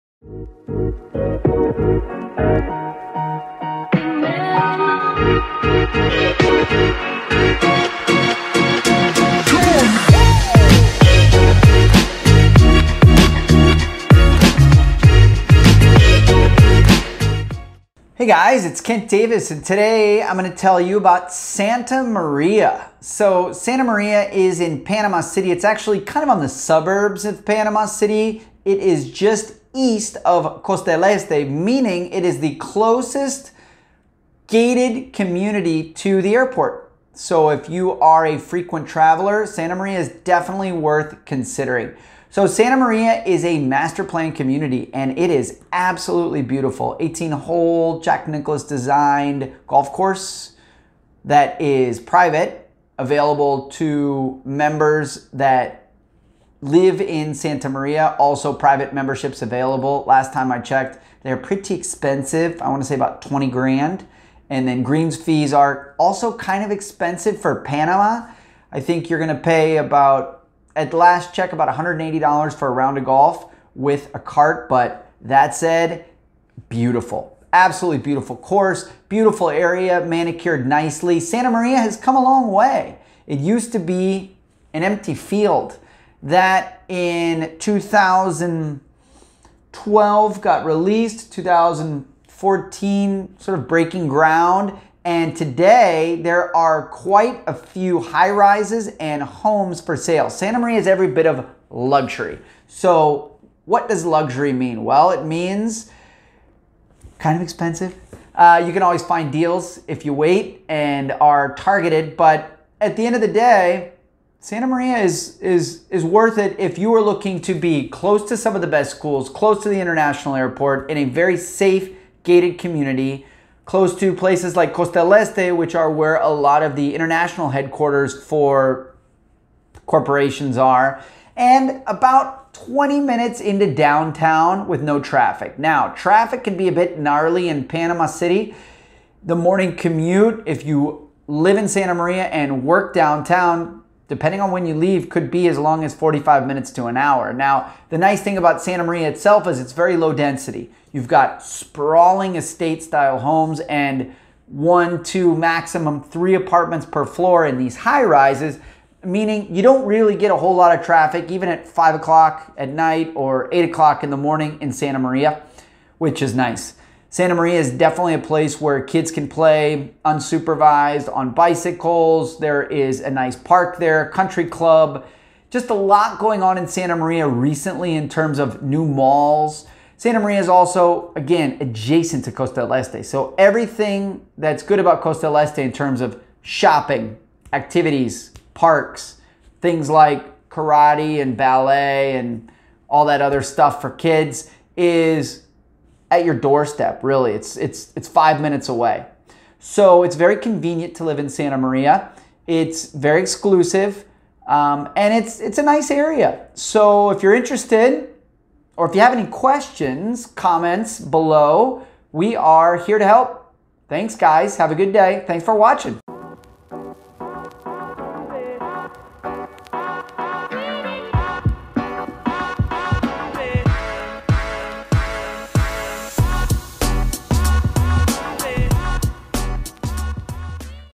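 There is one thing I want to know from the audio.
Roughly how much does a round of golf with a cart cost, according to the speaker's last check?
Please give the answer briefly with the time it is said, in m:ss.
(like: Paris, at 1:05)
$180, at 1:11.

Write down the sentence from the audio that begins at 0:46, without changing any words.
18 hole Jack Nicklaus designed golf course that is private, available to members that live in Santa Maria, also private memberships available.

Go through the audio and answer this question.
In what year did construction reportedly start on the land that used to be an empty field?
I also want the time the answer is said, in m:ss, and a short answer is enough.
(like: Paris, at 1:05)
2014, at 1:31.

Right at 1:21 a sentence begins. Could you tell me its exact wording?
Santa Maria has come a long way.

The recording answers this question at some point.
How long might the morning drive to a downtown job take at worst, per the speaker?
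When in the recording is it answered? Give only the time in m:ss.
2:25.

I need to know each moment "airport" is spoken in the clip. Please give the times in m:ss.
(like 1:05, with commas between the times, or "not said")
0:36, 2:00.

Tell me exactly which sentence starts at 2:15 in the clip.
Now, traffic can be a bit gnarly in Panama City.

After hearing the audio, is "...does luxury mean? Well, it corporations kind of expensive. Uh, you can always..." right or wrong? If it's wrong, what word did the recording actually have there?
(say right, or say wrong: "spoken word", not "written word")
wrong: "means", not "corporations".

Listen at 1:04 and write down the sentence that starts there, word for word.
And then greens fees are also kind of expensive for Panama.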